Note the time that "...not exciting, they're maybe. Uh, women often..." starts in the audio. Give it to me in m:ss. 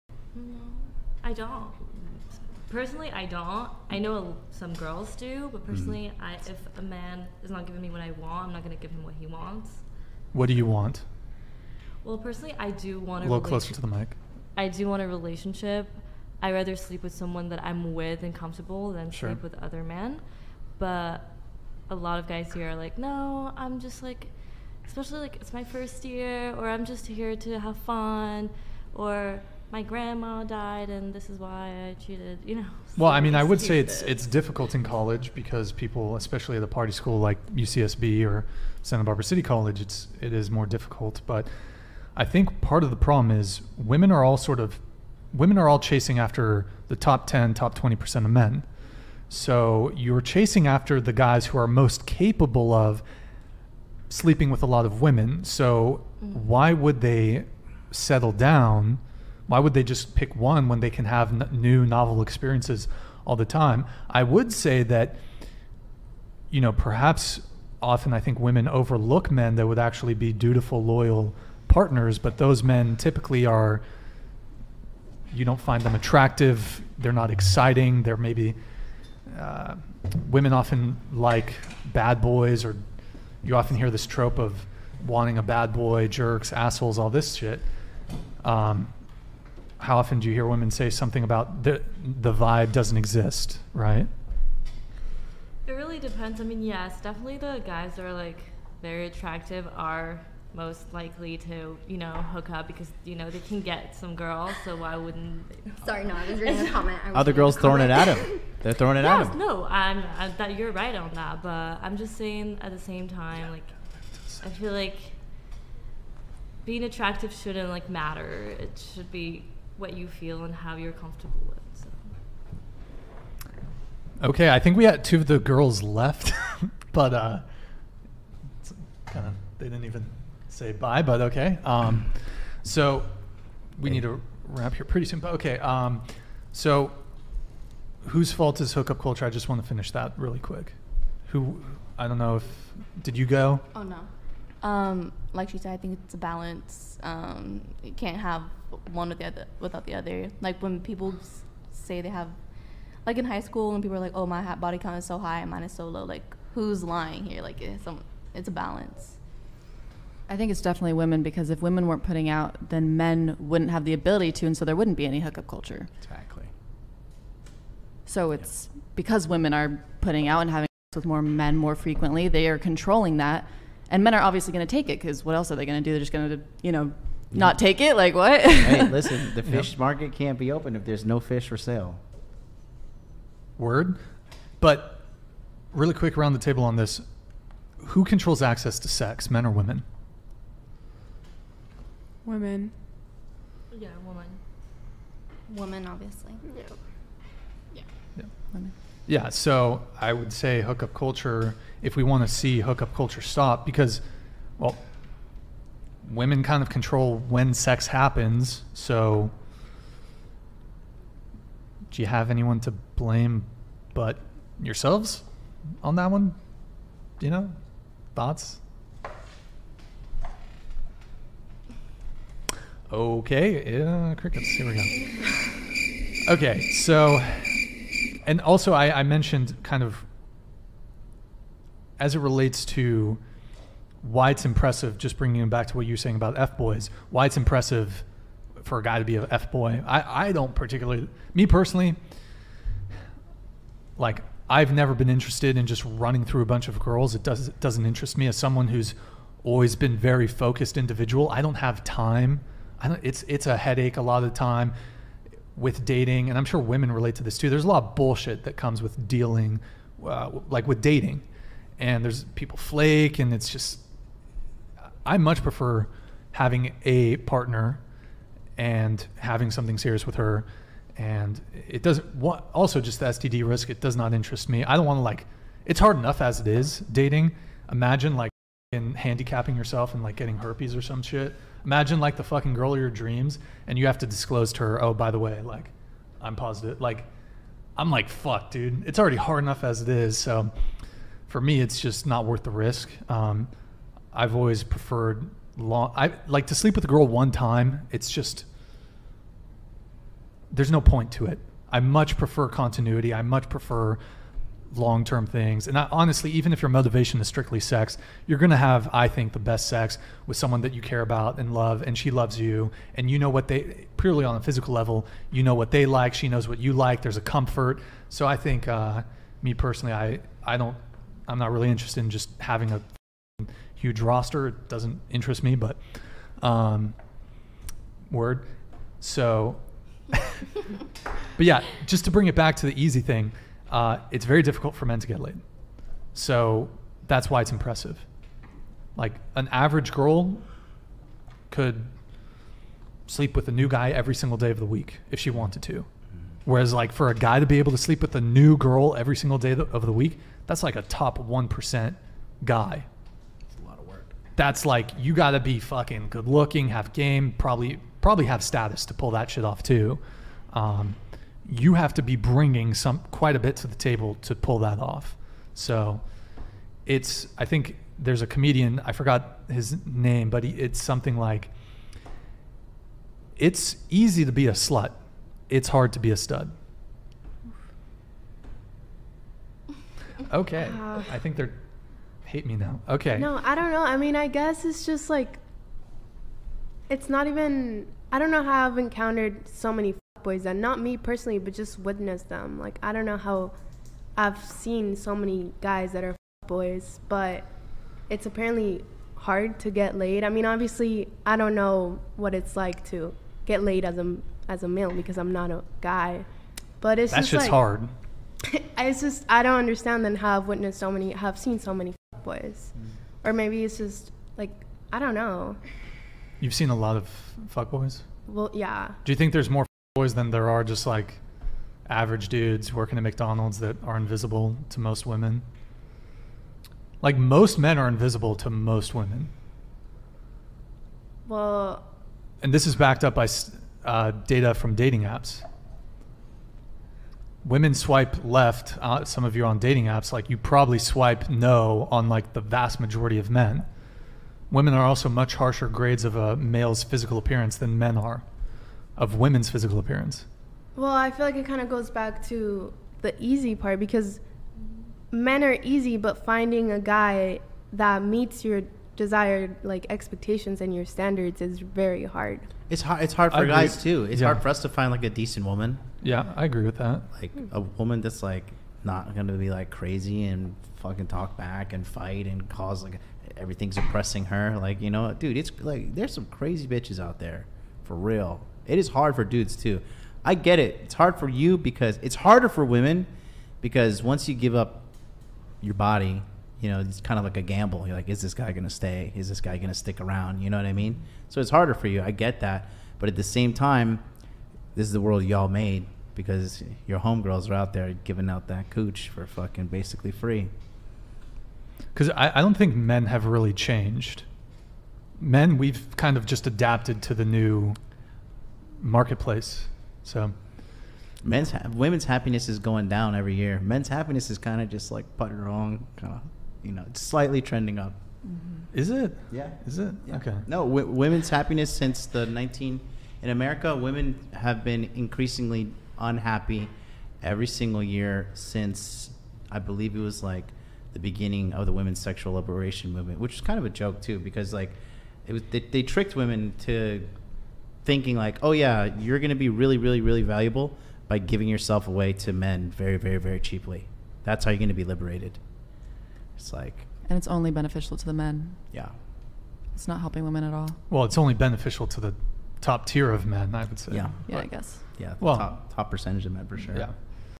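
1:17.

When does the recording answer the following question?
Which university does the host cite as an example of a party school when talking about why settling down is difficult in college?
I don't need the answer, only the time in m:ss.
0:37.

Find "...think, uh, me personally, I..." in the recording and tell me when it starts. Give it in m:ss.
5:18.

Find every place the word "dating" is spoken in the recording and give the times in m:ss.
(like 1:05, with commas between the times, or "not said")
4:15, 4:20, 4:36, 7:14, 7:19.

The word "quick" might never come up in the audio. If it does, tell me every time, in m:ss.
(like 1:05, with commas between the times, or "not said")
2:20, 3:05.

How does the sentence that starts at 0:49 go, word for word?
So you're chasing after the guys who are most capable of sleeping with a lot of women.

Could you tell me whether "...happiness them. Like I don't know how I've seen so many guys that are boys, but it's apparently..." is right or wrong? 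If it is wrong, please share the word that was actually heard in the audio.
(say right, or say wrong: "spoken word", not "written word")
wrong: "witness", not "happiness".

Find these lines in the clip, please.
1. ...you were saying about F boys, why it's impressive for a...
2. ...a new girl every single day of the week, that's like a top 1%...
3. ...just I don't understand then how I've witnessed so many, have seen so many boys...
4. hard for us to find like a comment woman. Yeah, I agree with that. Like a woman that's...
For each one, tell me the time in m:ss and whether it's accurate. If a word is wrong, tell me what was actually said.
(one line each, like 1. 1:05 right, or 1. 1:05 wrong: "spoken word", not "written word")
1. 3:55 right
2. 5:48 right
3. 6:49 right
4. 7:44 wrong: "decent", not "comment".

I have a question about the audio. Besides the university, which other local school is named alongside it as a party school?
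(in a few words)
Santa Barbara City College.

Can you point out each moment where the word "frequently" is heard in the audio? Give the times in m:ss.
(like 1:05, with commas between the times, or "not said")
2:51.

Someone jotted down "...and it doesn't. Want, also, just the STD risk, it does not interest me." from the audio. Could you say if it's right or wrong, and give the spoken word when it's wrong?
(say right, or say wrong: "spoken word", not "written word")
right.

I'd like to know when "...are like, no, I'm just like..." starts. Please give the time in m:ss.
0:22.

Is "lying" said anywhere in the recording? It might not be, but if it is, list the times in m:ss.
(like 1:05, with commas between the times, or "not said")
2:36.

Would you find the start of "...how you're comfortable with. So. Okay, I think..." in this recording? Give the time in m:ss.
2:00.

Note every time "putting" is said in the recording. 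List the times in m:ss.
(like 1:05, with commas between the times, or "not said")
2:42, 2:50, 8:35.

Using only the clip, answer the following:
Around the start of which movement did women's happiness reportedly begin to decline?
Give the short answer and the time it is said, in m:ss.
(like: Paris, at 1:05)
women's sexual liberation movement, at 8:51.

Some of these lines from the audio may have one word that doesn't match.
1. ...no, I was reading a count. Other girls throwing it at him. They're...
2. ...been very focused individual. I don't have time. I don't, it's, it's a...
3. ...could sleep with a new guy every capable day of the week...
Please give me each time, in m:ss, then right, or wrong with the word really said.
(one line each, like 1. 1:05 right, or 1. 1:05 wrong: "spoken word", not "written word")
1. 1:46 wrong: "comment", not "count"
2. 4:09 right
3. 5:41 wrong: "single", not "capable".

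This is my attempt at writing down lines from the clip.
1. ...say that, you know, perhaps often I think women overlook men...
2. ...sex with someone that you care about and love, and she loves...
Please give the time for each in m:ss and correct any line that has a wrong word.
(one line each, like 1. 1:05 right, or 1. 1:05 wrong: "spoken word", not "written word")
1. 1:04 right
2. 5:09 right.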